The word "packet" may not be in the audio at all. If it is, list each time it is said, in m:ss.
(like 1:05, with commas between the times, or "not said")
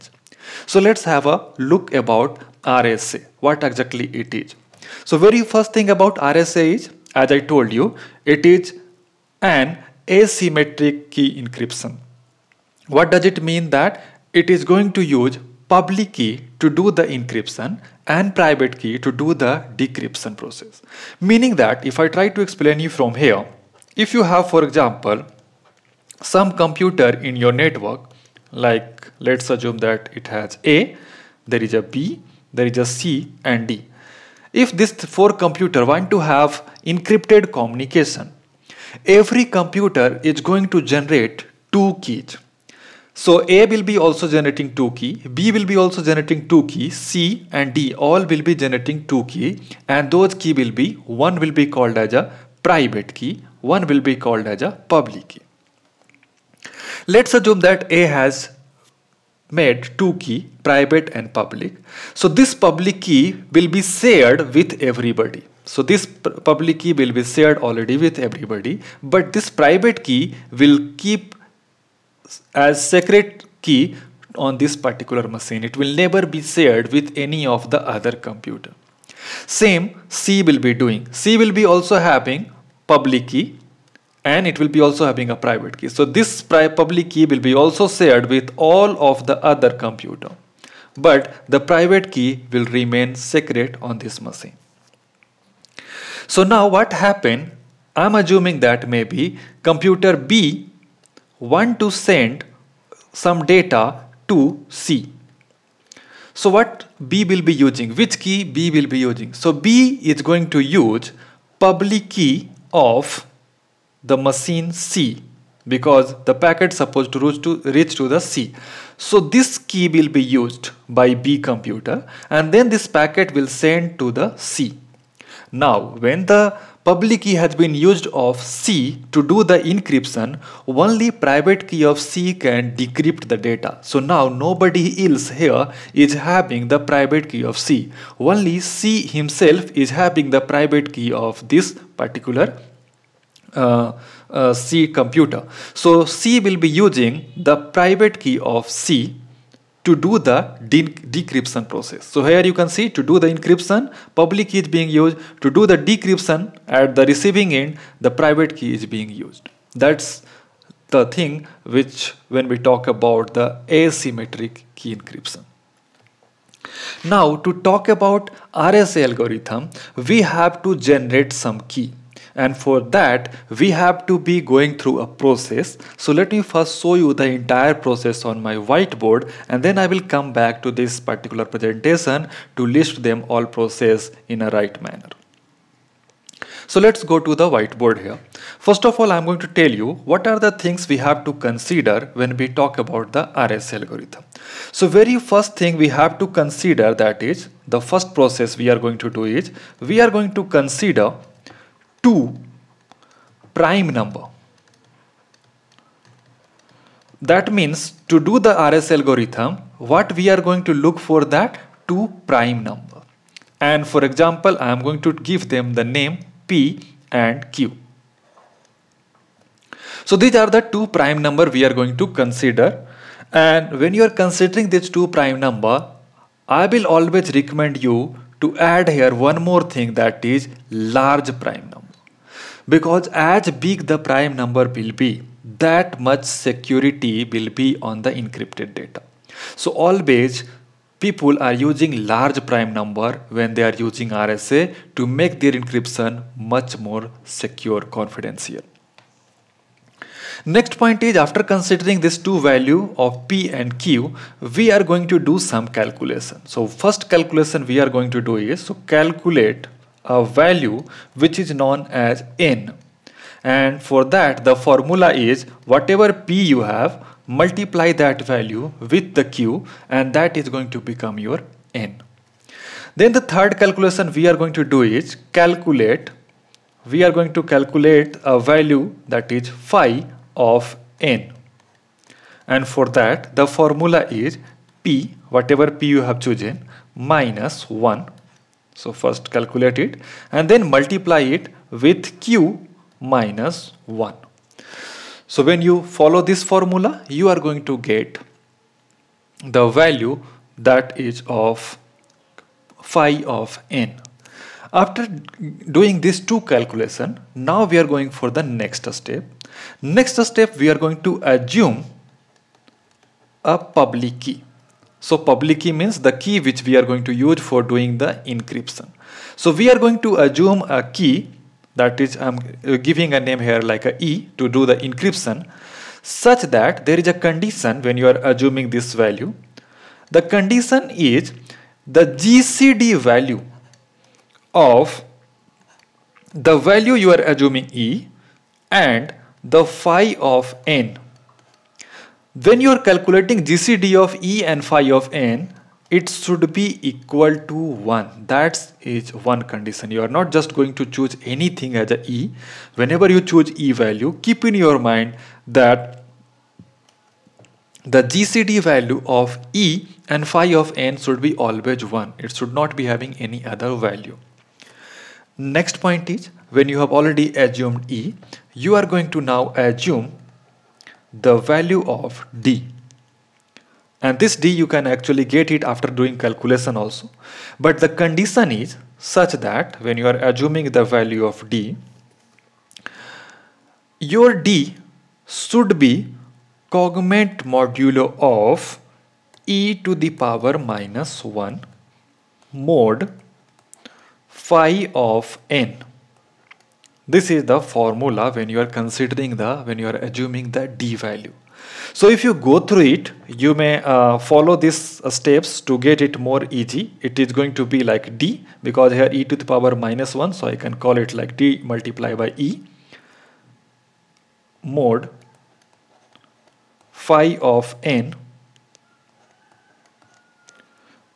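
1:56, 2:02.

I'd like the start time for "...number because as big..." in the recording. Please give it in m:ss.
3:51.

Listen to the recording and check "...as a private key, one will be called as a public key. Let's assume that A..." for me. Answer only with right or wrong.
right.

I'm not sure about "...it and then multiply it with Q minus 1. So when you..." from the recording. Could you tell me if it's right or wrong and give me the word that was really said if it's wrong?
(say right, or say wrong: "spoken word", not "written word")
right.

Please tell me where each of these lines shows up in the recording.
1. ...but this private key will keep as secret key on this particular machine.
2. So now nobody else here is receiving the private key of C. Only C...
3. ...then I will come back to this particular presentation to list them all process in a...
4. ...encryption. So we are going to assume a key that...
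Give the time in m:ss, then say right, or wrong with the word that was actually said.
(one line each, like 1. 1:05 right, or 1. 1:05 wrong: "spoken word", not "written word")
1. 1:09 right
2. 2:13 wrong: "having", not "receiving"
3. 2:59 right
4. 5:18 right.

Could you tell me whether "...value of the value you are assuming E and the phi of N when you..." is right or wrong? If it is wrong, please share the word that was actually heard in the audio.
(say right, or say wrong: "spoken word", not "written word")
right.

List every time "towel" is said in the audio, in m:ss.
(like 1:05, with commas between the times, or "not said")
not said.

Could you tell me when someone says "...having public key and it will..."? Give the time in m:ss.
1:21.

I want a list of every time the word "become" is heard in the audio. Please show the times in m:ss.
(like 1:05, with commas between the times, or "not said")
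4:30.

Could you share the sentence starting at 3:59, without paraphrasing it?
So always people are using large prime number when they are using RSA to make their encryption much more secure confidential.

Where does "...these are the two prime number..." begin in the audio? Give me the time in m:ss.
3:40.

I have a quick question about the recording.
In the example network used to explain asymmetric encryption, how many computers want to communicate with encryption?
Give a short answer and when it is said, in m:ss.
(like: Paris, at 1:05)
4, at 0:35.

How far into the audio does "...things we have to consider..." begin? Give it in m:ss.
3:10.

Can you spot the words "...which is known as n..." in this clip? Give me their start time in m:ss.
4:21.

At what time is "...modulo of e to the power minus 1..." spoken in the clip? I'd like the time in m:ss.
6:27.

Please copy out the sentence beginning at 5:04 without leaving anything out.
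After doing these two calculation, now we are going for the next step.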